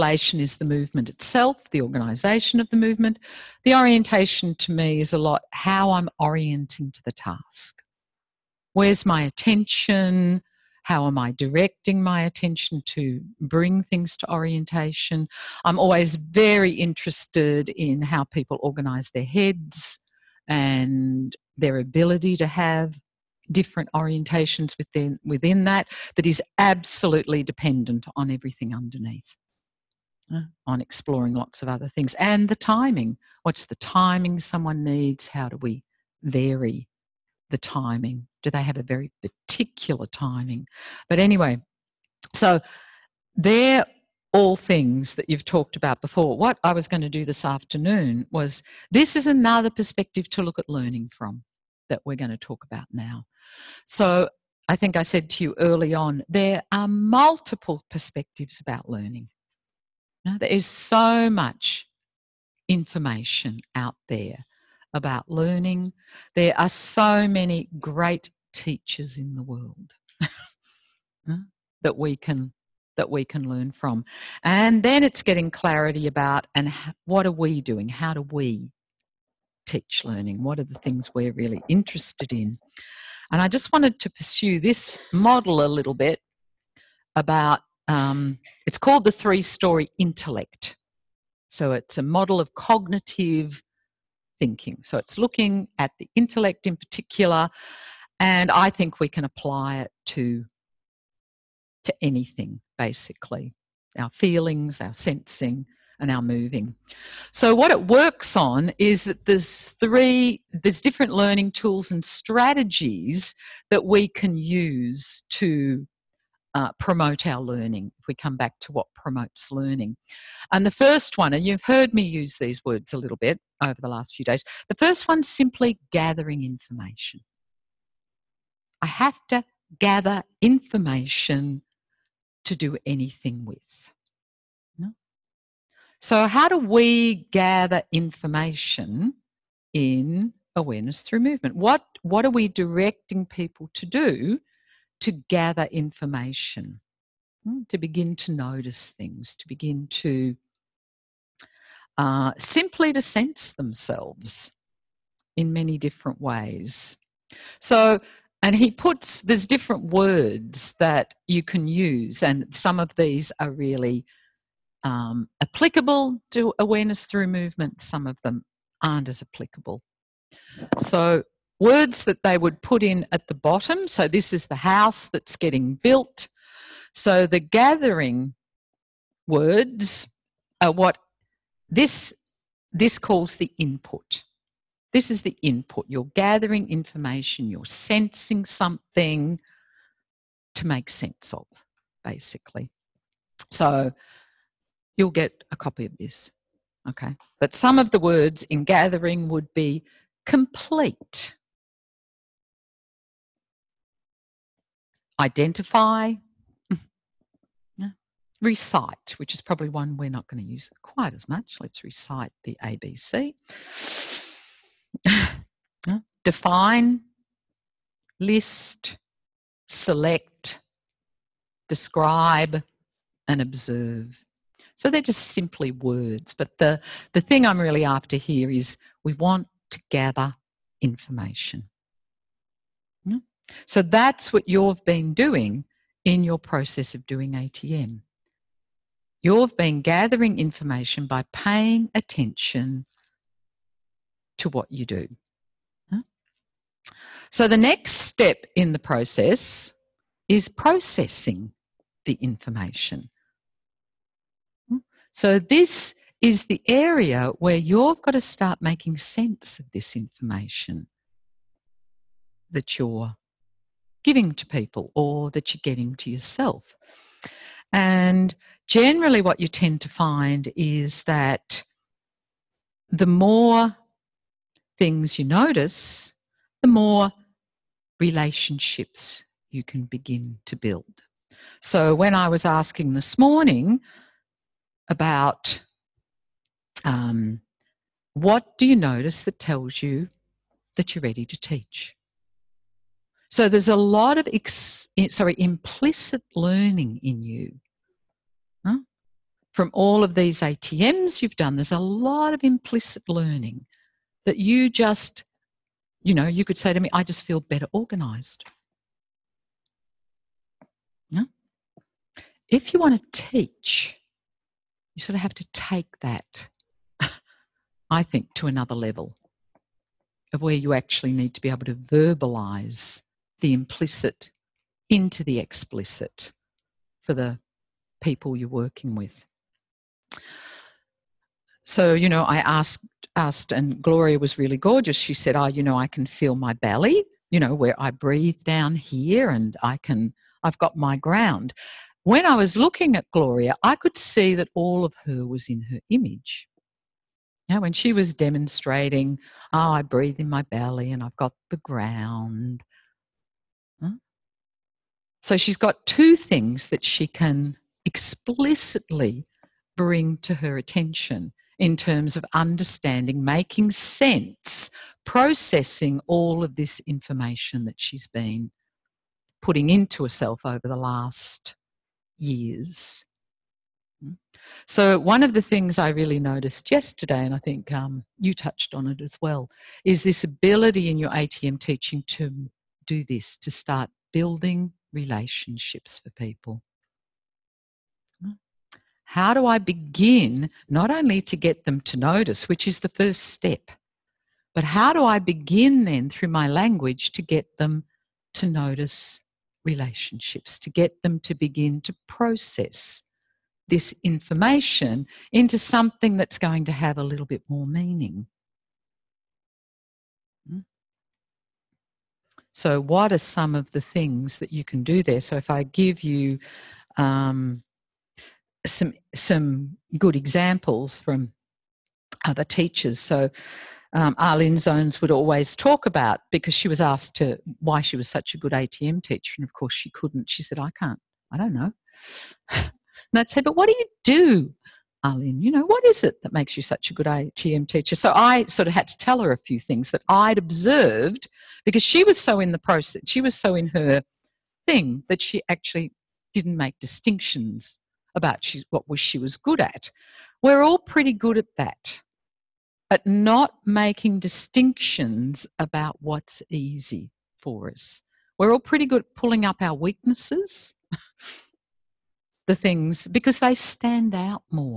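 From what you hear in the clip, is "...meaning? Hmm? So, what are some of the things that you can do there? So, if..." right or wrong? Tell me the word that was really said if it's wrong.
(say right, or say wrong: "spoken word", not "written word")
right.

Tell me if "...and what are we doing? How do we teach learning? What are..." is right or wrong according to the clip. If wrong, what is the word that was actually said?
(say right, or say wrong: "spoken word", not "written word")
right.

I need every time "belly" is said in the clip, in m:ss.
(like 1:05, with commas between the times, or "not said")
5:36, 5:50.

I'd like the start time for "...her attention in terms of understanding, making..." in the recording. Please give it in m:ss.
6:00.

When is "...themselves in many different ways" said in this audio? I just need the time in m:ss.
2:33.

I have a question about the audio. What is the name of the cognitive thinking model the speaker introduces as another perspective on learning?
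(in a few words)
three story intellect.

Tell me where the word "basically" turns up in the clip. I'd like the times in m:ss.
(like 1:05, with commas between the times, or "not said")
1:42, 3:12.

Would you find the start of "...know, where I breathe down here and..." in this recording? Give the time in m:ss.
5:37.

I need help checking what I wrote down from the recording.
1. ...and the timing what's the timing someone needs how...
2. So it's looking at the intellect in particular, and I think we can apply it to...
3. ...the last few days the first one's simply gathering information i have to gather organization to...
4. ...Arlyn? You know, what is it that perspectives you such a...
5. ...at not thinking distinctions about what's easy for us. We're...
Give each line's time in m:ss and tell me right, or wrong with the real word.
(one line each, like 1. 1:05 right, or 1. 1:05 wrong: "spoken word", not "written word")
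1. 0:32 right
2. 1:34 right
3. 2:03 wrong: "information", not "organization"
4. 7:15 wrong: "makes", not "perspectives"
5. 7:32 wrong: "making", not "thinking".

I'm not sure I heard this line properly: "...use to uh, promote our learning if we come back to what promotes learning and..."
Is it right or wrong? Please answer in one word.
right.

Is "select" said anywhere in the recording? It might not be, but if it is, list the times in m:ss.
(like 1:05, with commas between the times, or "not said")
3:39.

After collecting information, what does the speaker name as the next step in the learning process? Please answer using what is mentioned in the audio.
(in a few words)
processing the information.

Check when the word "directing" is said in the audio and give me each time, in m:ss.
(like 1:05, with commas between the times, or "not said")
0:11, 2:22.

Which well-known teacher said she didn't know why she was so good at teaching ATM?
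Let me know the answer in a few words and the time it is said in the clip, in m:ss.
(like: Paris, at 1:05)
Arlyn Zones, at 7:04.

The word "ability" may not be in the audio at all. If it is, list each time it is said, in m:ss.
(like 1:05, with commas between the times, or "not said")
0:21, 6:20.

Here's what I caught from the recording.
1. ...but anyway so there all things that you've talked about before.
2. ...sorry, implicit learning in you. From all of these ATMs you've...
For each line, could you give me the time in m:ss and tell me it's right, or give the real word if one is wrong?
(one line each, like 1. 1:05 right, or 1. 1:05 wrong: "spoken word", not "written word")
1. 0:41 right
2. 4:55 right.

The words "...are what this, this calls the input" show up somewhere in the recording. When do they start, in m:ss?
3:00.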